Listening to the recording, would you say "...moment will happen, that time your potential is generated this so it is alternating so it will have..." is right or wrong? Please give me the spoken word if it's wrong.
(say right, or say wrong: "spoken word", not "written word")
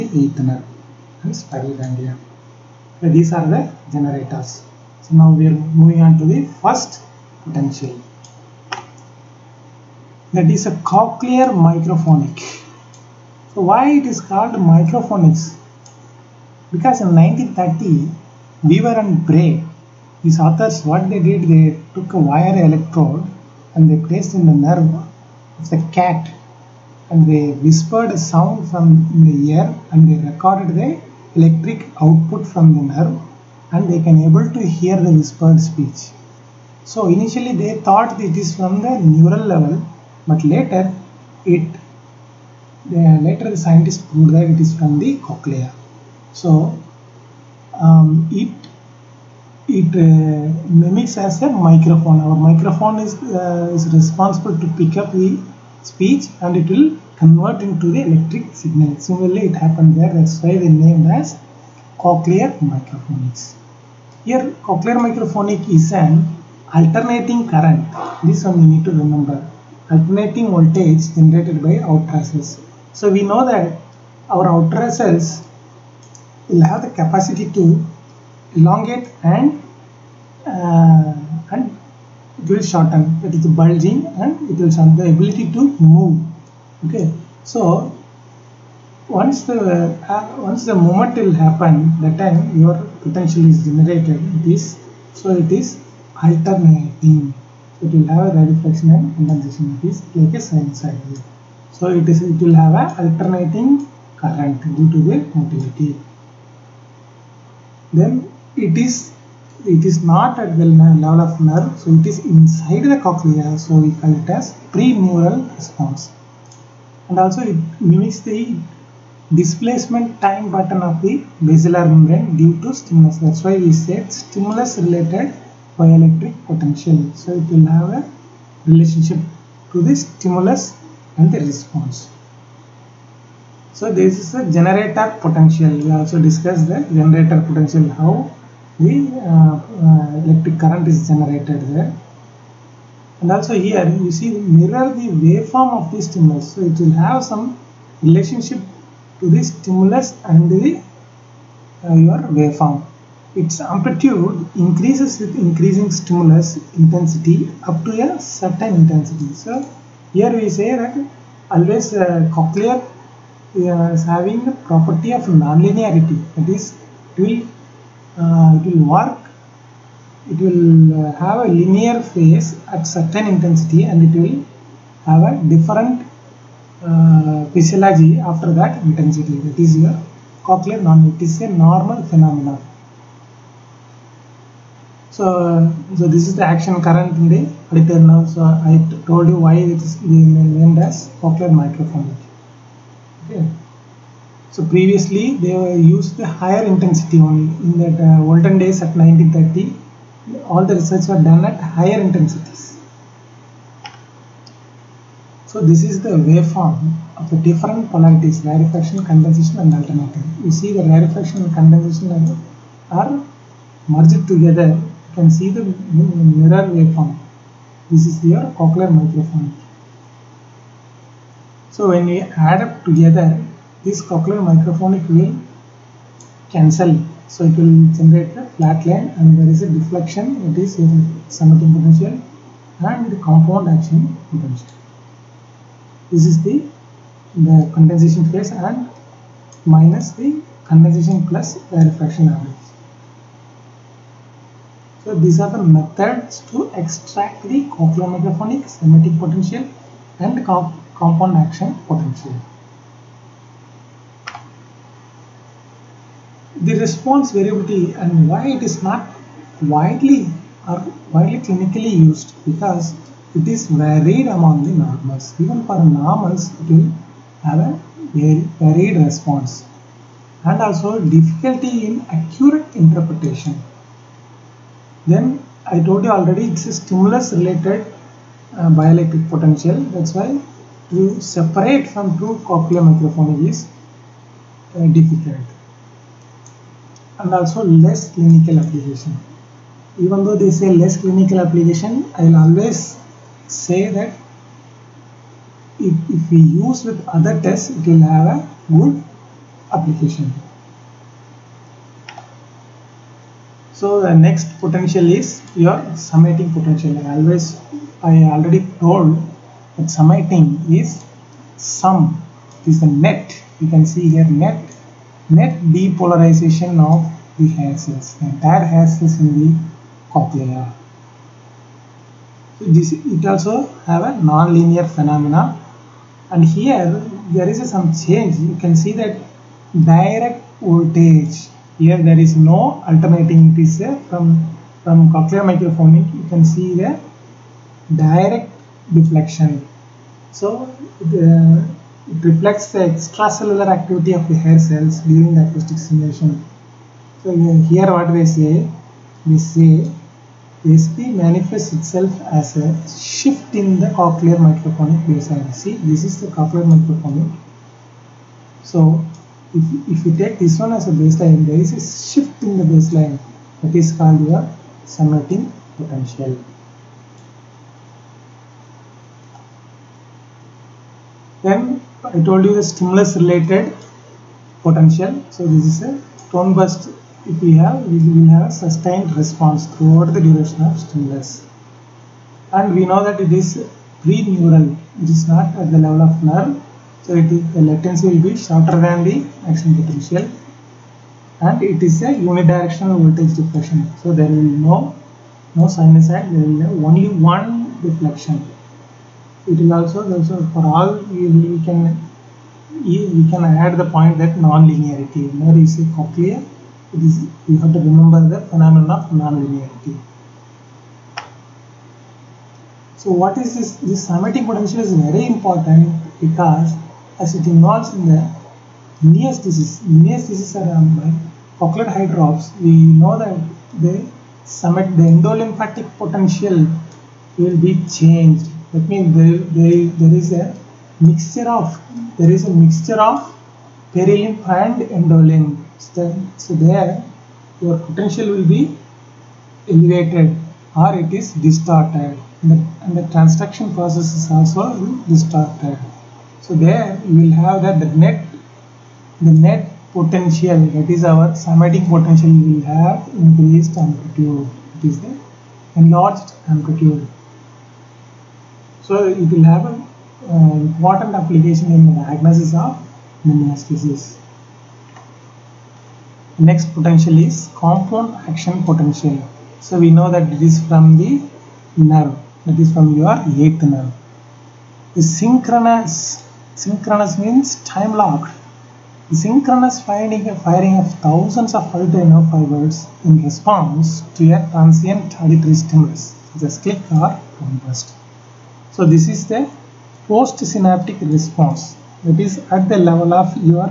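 right.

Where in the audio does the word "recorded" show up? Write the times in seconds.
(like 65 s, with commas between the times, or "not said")
30 s.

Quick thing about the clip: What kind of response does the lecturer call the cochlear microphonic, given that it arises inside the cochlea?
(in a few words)
Pre-neural response.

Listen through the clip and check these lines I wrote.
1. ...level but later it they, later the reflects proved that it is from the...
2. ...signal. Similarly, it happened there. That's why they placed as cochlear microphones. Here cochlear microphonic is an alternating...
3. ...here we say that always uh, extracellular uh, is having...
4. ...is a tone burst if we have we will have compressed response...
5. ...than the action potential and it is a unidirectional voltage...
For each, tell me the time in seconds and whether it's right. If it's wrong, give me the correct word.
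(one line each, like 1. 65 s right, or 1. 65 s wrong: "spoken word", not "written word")
1. 39 s wrong: "scientists", not "reflects"
2. 58 s wrong: "named", not "placed"
3. 160 s wrong: "cochlear", not "extracellular"
4. 375 s wrong: "sustained", not "compressed"
5. 388 s right.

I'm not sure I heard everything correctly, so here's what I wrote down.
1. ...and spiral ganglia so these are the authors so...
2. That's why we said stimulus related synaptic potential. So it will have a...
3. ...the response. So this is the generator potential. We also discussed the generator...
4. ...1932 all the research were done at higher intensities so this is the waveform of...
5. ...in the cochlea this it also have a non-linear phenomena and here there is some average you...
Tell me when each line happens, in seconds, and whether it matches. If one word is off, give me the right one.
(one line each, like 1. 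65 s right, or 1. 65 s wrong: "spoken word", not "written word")
1. 1 s wrong: "generators", not "authors"
2. 123 s wrong: "bioelectric", not "synaptic"
3. 131 s right
4. 199 s wrong: "1930", not "1932"
5. 319 s wrong: "change", not "average".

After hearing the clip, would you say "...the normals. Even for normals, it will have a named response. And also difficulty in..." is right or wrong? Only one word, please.
wrong.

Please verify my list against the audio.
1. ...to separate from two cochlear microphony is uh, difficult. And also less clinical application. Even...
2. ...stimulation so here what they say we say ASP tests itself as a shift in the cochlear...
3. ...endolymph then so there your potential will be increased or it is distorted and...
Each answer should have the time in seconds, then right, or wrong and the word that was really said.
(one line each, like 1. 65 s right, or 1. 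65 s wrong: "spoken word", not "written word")
1. 280 s right
2. 345 s wrong: "manifests", not "tests"
3. 434 s wrong: "elevated", not "increased".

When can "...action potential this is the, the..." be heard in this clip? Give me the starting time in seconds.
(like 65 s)
233 s.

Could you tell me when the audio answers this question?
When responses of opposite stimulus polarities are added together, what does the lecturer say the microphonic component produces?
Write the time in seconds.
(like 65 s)
228 s.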